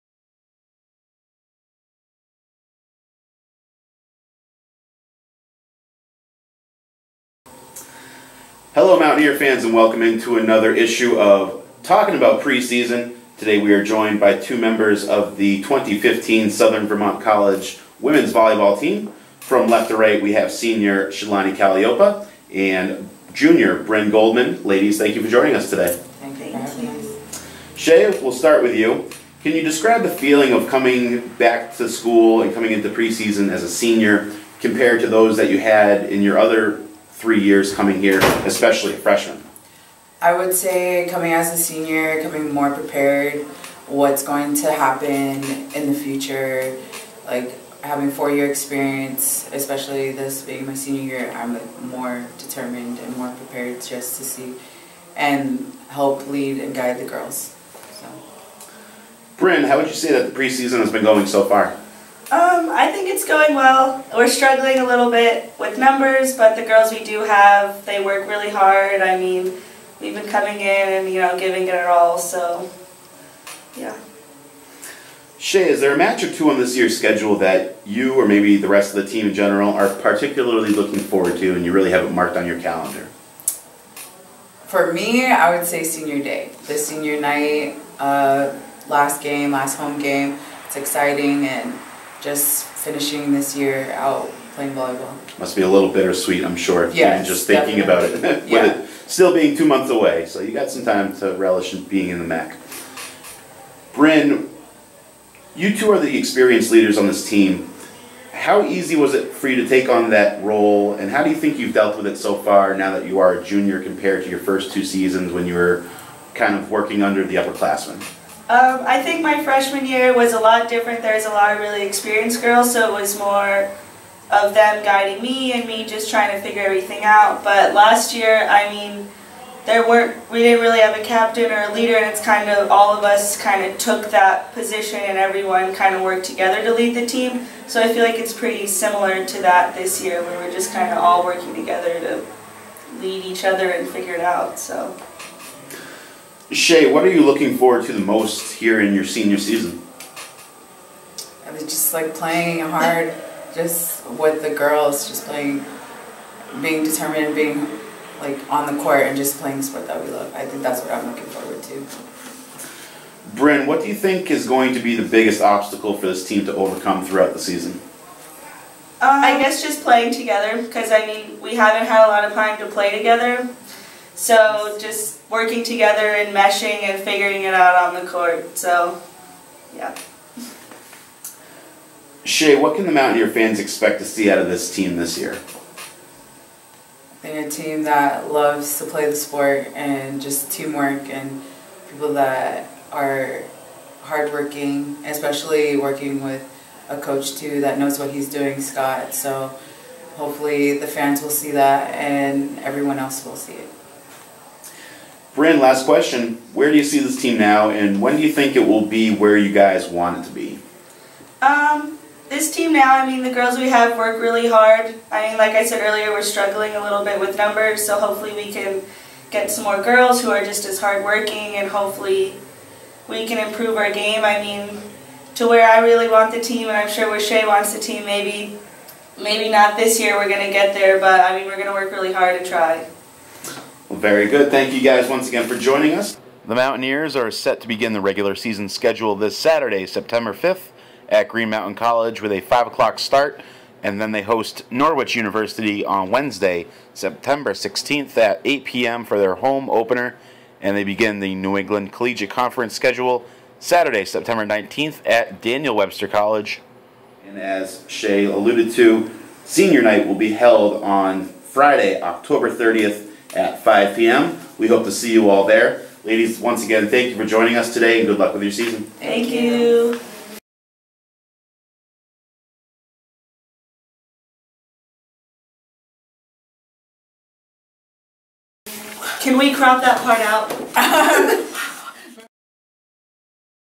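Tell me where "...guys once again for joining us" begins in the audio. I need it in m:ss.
3:54.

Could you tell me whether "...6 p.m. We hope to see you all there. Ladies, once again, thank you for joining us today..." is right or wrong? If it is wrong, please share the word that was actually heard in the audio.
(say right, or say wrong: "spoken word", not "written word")
wrong: "5", not "6".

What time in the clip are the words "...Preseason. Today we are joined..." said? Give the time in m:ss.
0:12.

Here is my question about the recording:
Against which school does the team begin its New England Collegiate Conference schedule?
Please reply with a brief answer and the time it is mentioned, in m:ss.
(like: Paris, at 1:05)
Daniel Webster College, at 4:15.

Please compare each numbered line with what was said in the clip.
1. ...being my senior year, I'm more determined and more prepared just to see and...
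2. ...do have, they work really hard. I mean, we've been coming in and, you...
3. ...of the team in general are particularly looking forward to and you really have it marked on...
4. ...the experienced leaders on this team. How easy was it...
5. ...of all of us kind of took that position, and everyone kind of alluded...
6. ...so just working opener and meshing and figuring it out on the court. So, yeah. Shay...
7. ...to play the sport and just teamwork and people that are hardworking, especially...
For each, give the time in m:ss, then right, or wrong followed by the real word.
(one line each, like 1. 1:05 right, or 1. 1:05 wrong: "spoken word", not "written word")
1. 0:50 right
2. 1:07 right
3. 1:18 right
4. 1:45 right
5. 2:12 wrong: "worked", not "alluded"
6. 2:54 wrong: "together", not "opener"
7. 3:08 right.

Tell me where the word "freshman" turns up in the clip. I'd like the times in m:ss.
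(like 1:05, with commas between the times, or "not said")
0:38, 1:59.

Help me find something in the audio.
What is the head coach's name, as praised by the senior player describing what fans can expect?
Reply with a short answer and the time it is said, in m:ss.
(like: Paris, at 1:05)
Scott, at 3:18.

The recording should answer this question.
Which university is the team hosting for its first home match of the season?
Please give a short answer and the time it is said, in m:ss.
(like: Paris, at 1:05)
Norwich University, at 4:04.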